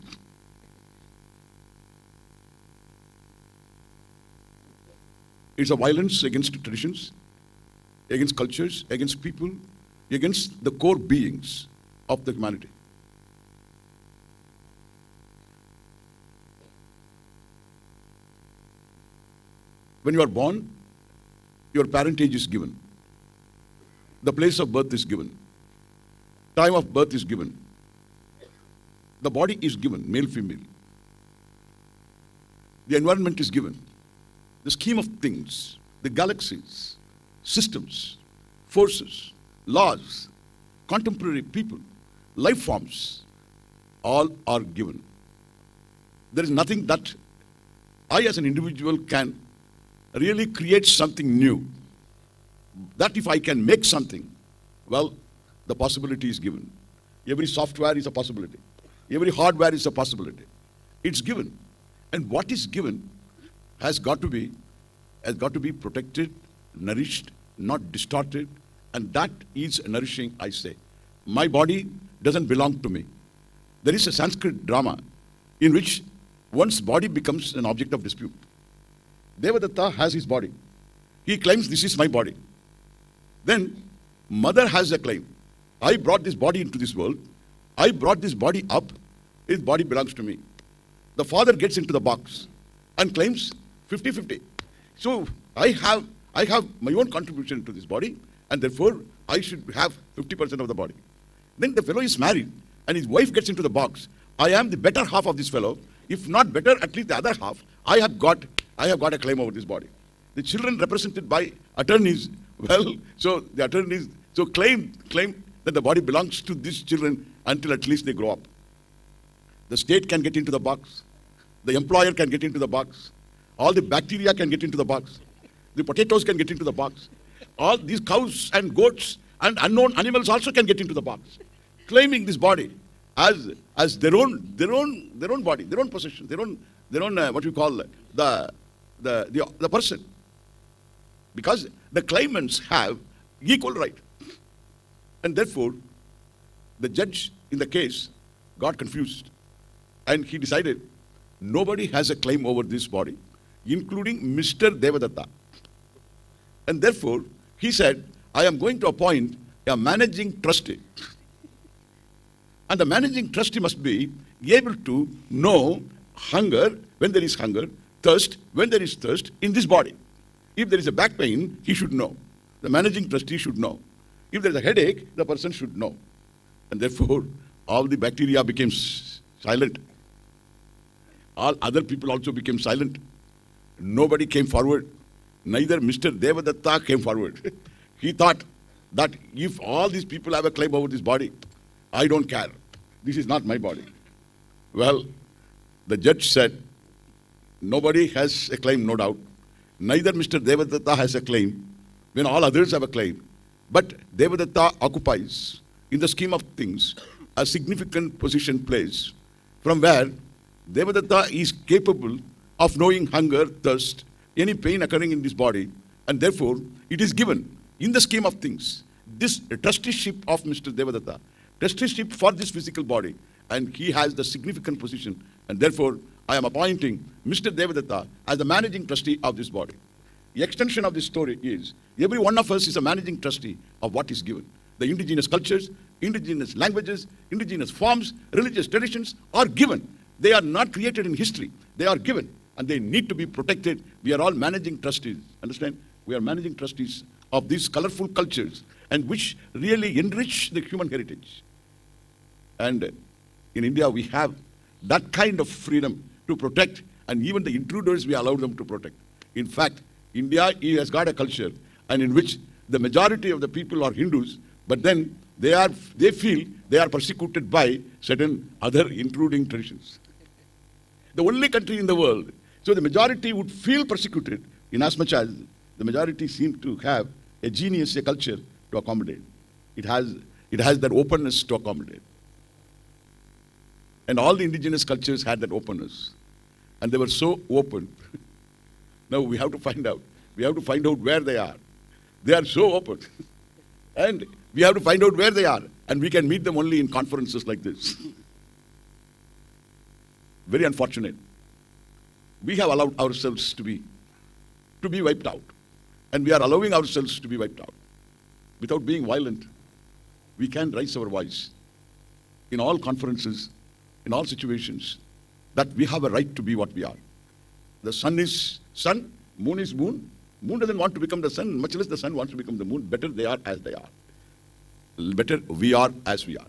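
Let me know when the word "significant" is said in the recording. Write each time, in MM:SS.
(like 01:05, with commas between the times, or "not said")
03:27, 03:44.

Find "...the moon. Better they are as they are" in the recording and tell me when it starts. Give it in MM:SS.
05:22.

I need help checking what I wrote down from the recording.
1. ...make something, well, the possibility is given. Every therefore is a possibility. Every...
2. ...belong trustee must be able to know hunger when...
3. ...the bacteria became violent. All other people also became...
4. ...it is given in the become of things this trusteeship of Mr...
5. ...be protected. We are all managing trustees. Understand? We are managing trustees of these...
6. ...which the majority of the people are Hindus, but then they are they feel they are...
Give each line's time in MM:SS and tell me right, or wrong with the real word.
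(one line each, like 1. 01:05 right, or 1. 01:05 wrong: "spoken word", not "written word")
1. 00:53 wrong: "software", not "therefore"
2. 02:42 wrong: "managing", not "belong"
3. 02:57 wrong: "silent", not "violent"
4. 03:36 wrong: "scheme", not "become"
5. 04:03 right
6. 04:22 right.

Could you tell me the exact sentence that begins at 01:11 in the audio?
My body doesn't belong to me.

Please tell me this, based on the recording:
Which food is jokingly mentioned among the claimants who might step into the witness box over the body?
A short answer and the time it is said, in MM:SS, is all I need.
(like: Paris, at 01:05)
potatoes, at 02:05.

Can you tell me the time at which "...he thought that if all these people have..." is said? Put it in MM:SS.
03:08.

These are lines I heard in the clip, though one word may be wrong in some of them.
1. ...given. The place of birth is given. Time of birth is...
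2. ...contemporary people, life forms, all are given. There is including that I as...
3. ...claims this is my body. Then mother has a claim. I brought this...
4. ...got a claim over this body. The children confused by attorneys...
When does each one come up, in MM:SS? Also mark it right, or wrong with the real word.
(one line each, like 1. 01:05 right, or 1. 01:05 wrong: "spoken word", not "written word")
1. 00:22 right
2. 00:40 wrong: "nothing", not "including"
3. 01:21 right
4. 01:49 wrong: "represented", not "confused".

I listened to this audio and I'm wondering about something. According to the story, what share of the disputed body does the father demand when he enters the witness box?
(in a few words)
50%.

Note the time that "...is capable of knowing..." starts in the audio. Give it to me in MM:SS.
03:31.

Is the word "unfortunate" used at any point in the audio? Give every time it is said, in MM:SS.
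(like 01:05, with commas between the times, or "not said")
05:00.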